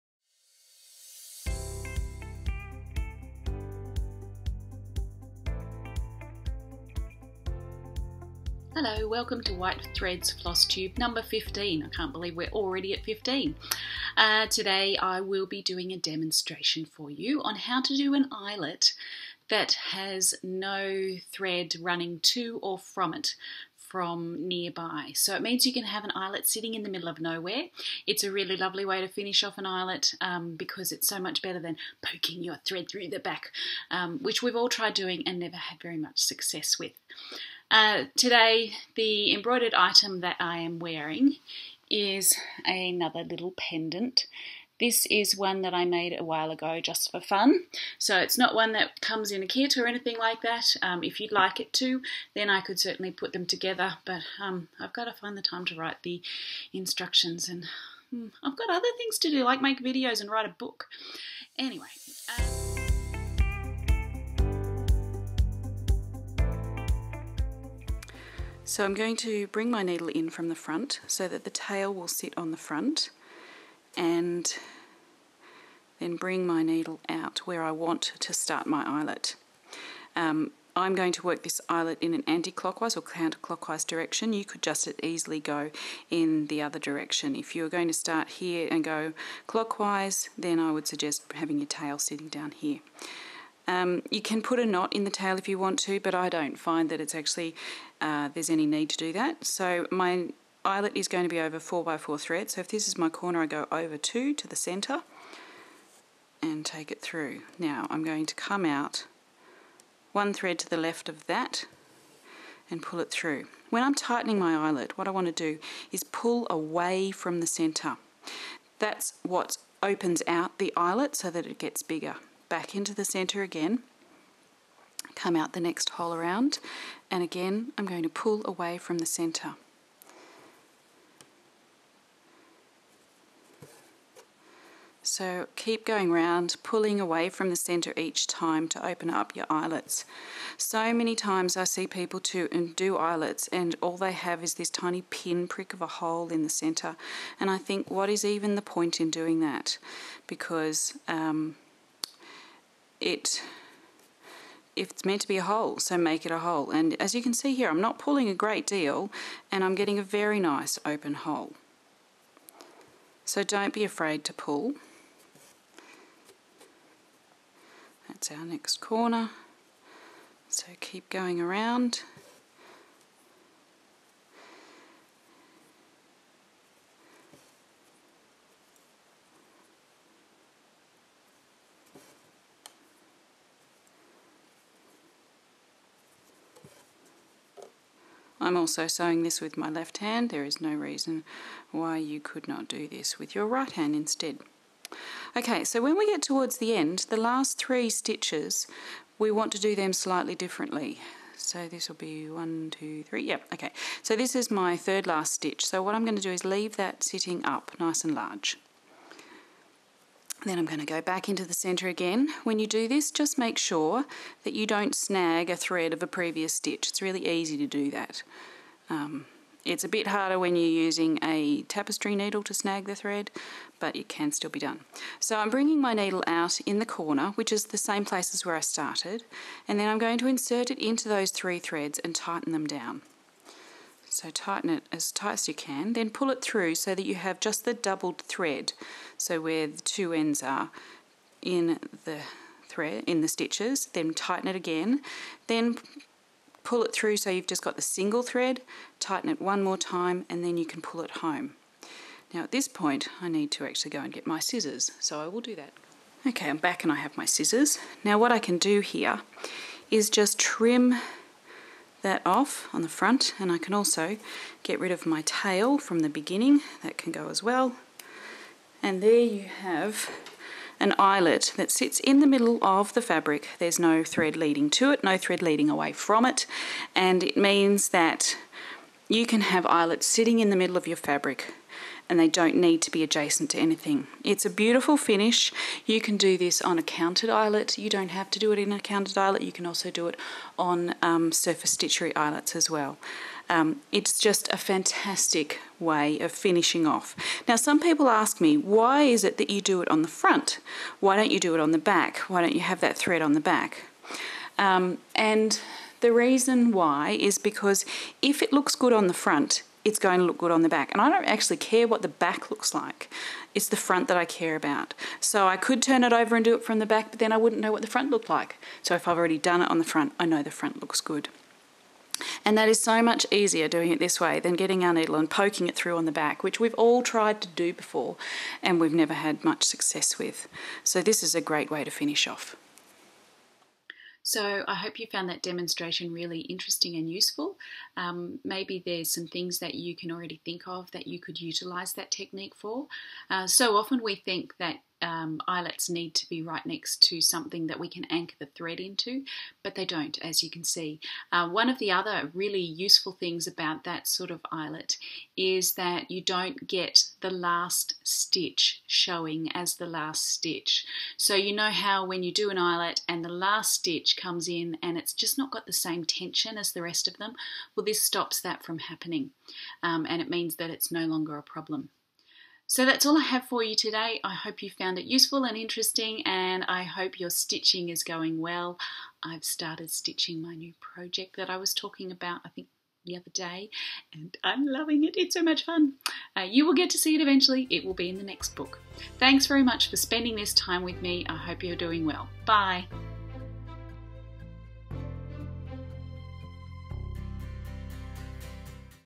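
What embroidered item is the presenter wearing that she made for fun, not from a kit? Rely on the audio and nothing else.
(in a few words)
pendant.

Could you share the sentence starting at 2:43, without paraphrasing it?
So don't be afraid to pull.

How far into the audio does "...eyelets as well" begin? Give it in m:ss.
4:52.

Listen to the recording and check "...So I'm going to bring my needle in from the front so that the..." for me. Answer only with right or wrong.
right.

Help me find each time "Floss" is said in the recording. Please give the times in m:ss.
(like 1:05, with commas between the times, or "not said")
0:10.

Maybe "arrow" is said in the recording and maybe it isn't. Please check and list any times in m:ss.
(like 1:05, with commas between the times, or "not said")
not said.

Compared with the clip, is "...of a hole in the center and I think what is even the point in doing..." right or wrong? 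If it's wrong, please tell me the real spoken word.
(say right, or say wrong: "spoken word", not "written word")
right.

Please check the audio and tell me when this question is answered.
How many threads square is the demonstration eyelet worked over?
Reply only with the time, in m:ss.
1:41.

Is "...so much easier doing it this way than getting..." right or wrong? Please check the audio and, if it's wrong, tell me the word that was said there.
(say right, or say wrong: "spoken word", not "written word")
right.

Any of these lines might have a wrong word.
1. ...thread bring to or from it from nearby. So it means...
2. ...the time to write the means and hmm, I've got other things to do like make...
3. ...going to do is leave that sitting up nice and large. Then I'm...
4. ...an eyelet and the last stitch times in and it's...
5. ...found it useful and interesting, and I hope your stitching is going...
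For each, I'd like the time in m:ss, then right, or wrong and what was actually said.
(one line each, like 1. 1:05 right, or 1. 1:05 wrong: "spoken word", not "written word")
1. 0:21 wrong: "running", not "bring"
2. 0:55 wrong: "instructions", not "means"
3. 3:26 right
4. 6:02 wrong: "comes", not "times"
5. 6:14 right.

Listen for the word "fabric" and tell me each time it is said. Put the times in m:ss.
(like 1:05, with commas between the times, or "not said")
4:33, 4:40.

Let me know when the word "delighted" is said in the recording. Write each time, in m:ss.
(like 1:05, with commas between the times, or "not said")
not said.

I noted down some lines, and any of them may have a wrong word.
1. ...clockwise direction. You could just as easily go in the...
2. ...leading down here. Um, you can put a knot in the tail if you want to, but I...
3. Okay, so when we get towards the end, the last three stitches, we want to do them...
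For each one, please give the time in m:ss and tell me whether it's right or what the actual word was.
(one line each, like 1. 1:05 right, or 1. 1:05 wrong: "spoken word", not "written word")
1. 1:23 wrong: "counterclockwise", not "clockwise"
2. 1:31 wrong: "sitting", not "leading"
3. 3:15 right.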